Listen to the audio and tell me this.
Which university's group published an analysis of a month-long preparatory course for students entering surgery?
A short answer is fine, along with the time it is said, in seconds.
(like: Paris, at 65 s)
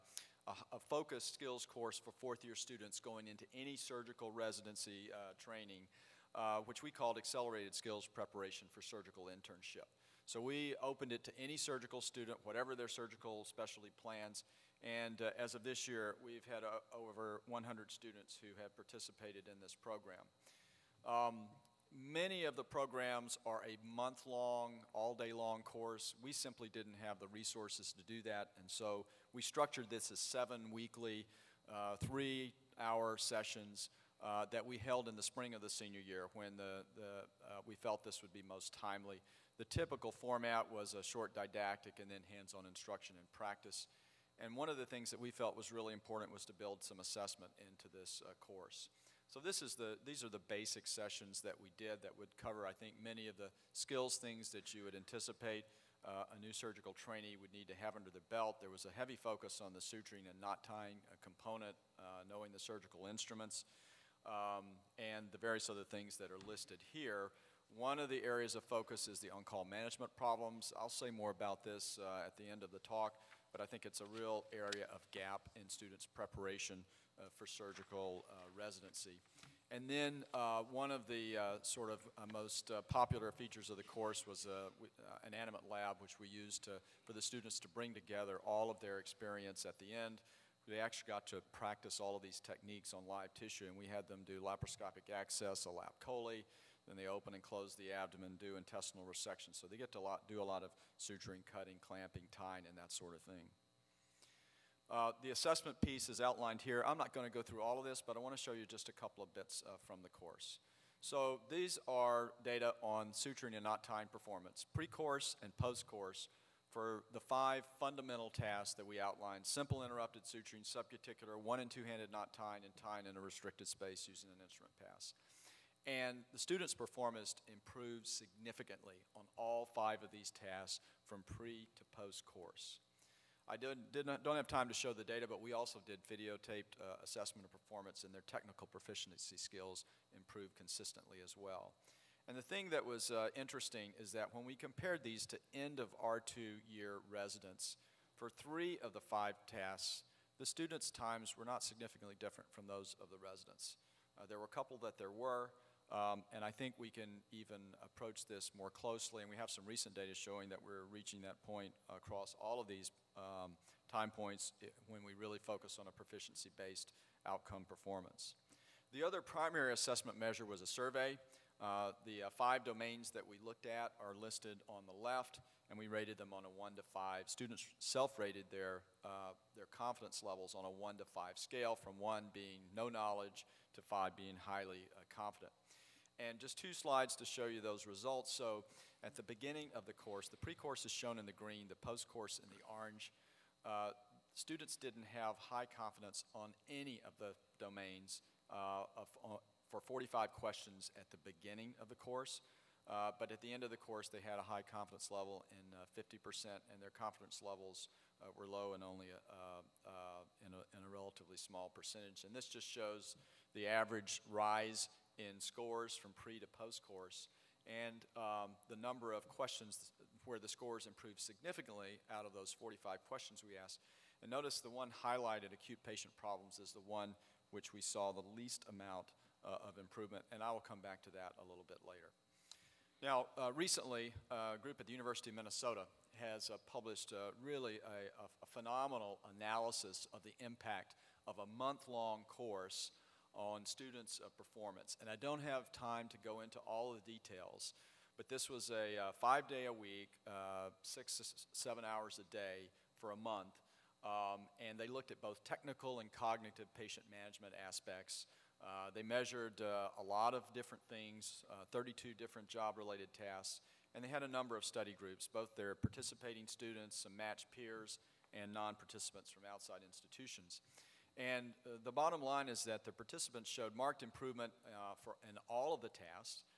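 University of Minnesota, at 234 s.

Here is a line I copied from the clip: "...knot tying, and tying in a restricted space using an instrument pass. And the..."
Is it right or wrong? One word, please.
right.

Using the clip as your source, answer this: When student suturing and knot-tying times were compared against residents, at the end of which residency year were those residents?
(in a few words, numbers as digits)
R2.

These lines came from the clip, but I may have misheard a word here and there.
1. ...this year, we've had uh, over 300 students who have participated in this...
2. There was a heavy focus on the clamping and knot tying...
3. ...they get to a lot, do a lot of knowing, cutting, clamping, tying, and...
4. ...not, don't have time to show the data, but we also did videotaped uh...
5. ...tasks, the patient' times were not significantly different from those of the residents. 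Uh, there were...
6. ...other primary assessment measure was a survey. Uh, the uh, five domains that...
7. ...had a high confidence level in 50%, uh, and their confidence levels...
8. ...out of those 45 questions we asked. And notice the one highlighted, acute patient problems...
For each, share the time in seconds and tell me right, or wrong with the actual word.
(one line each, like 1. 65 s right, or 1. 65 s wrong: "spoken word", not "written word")
1. 15 s wrong: "100", not "300"
2. 58 s wrong: "suturing", not "clamping"
3. 99 s wrong: "suturing", not "knowing"
4. 134 s right
5. 149 s wrong: "students", not "patient"
6. 169 s right
7. 204 s right
8. 222 s right.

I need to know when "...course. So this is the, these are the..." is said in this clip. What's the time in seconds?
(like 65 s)
48 s.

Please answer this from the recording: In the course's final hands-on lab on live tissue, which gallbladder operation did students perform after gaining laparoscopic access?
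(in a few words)
lap chole.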